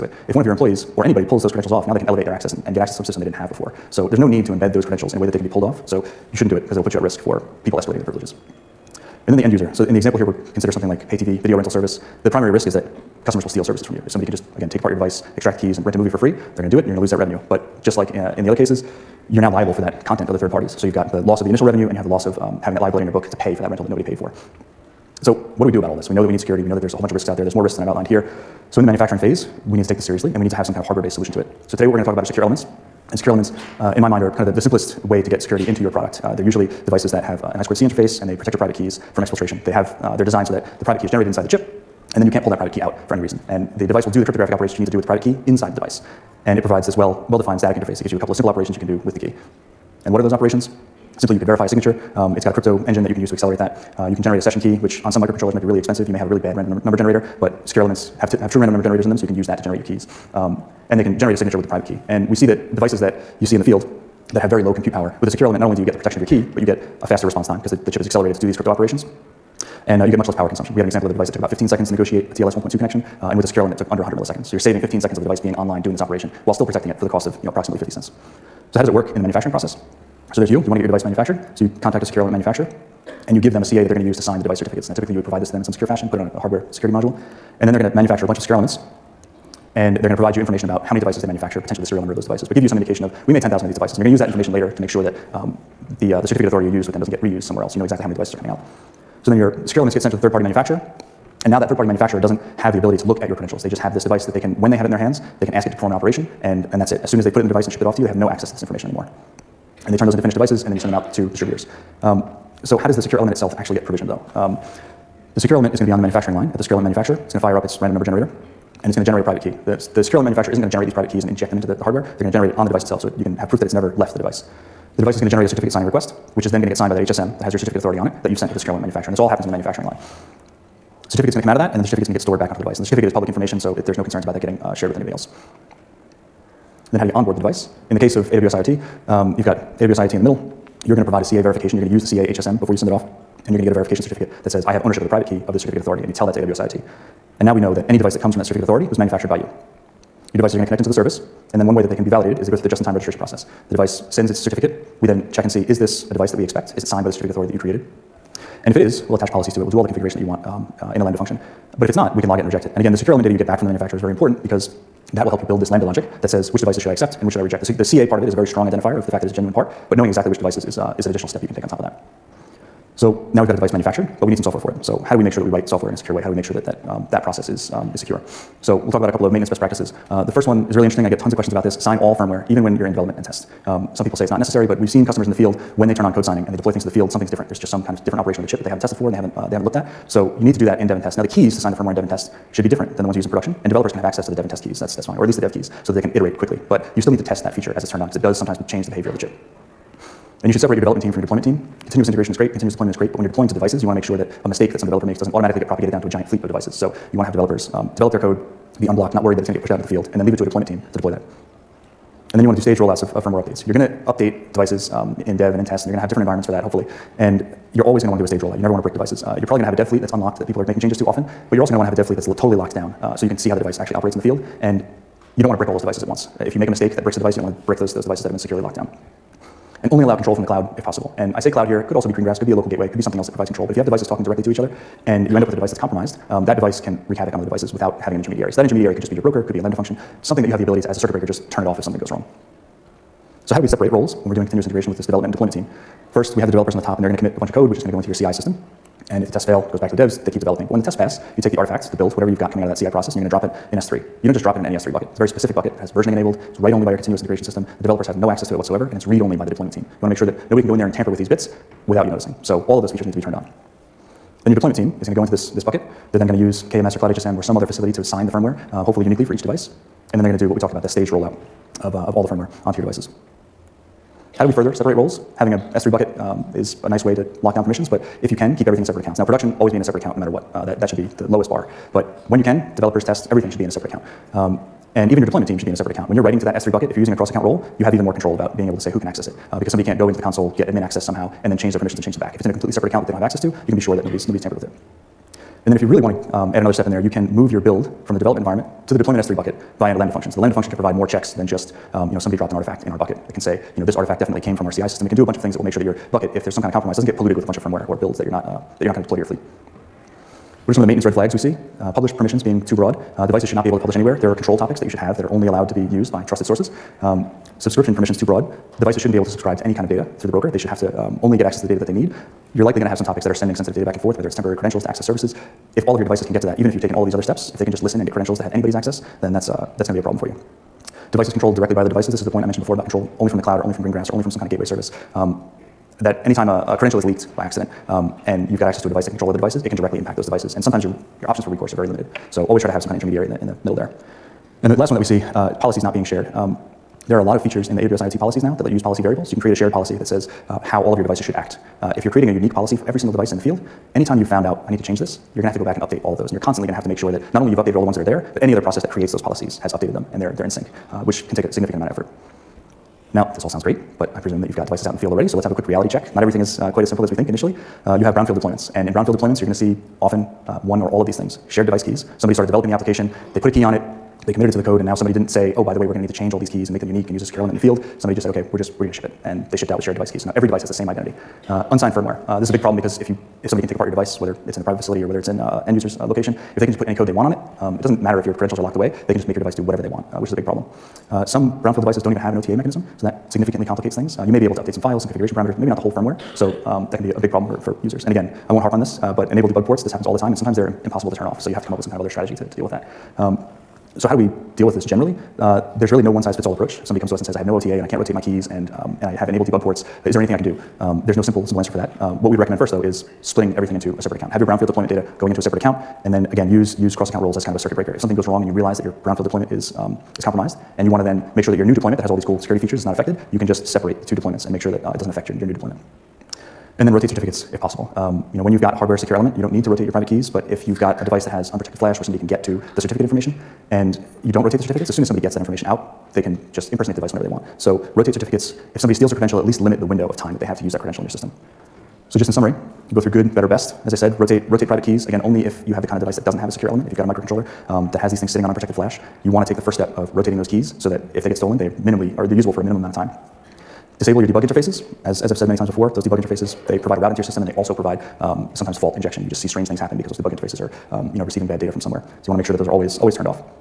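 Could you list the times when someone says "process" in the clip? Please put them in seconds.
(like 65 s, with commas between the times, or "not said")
79 s, 153 s, 177 s, 252 s, 358 s.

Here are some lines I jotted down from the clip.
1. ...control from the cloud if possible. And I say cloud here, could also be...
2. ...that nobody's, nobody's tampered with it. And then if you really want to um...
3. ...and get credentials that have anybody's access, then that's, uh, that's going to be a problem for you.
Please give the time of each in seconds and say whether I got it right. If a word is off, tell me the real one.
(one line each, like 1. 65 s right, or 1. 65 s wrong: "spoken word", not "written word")
1. 230 s right
2. 293 s right
3. 327 s right.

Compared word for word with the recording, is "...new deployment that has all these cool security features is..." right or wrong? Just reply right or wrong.
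right.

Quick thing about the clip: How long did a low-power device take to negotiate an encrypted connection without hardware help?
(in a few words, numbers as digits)
15 seconds.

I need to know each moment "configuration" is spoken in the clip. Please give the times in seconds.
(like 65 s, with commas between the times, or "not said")
159 s, 395 s.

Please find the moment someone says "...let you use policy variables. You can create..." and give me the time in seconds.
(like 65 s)
348 s.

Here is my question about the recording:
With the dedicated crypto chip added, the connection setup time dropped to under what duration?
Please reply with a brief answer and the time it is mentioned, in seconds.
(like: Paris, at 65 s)
100 milliseconds, at 73 s.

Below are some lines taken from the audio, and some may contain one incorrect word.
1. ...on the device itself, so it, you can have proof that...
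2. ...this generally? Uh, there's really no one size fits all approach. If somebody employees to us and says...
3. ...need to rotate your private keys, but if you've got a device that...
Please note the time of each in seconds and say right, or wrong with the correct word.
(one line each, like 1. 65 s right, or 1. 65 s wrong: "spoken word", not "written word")
1. 122 s right
2. 404 s wrong: "comes", not "employees"
3. 429 s right.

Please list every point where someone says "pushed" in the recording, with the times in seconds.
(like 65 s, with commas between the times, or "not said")
209 s.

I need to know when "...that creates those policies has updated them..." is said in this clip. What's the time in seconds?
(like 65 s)
358 s.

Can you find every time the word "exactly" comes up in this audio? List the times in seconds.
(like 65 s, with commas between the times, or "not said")
97 s, 170 s.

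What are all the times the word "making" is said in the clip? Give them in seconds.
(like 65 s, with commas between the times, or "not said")
220 s.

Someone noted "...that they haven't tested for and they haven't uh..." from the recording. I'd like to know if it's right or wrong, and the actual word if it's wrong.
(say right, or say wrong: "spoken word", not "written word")
right.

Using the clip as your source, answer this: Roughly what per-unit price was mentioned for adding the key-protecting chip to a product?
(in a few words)
50 cents.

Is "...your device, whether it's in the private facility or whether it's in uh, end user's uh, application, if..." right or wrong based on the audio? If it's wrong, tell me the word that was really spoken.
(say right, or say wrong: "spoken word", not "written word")
wrong: "location", not "application".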